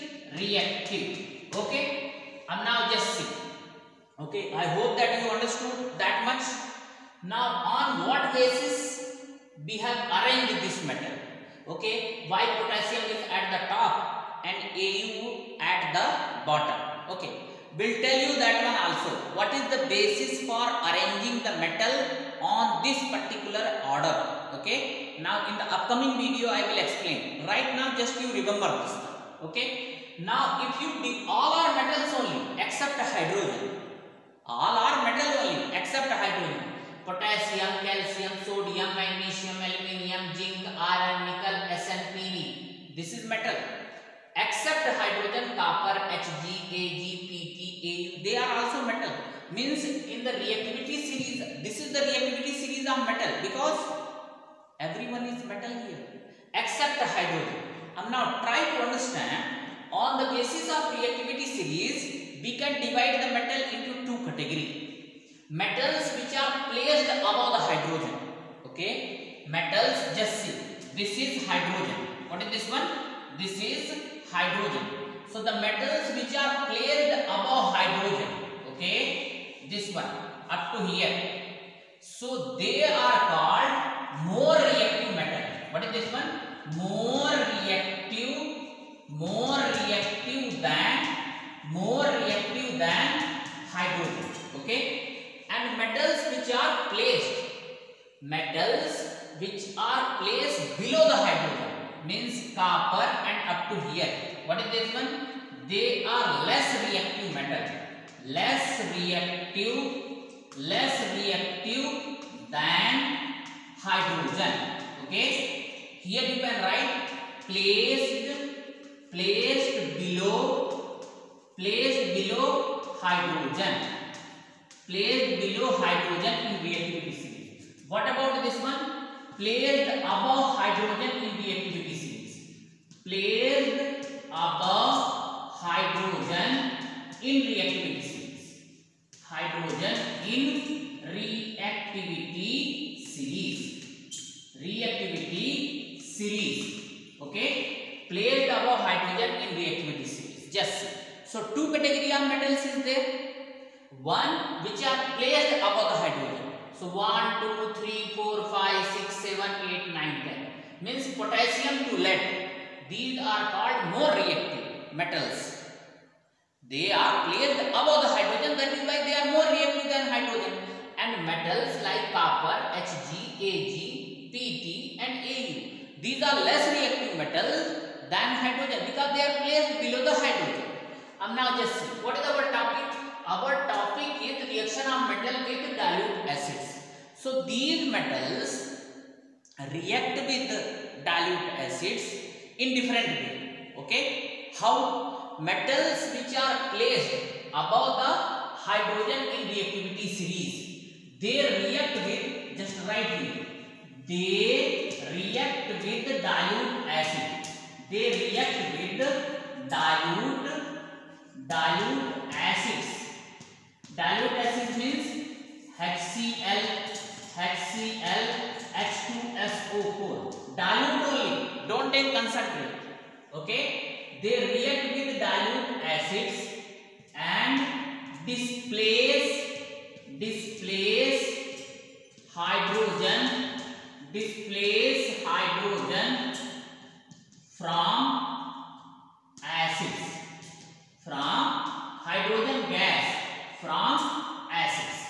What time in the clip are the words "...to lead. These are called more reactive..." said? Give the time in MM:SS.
02:41.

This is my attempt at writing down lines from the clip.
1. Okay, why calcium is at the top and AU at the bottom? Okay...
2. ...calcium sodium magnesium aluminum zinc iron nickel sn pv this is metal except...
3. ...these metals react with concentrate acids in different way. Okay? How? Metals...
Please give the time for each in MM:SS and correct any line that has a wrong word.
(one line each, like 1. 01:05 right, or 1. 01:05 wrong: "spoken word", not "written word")
1. 00:11 wrong: "potassium", not "calcium"
2. 00:37 right
3. 03:07 wrong: "dilute", not "concentrate".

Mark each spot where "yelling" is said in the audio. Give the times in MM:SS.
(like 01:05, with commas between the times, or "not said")
not said.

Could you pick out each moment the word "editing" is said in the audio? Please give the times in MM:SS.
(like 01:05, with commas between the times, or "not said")
not said.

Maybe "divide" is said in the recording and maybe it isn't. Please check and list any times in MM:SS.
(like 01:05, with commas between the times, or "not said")
01:02.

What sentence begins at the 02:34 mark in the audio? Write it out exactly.
One which are placed above the hydrogen.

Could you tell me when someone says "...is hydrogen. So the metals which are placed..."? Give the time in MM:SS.
01:13.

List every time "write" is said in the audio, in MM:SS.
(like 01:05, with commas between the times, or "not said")
01:56, 03:22.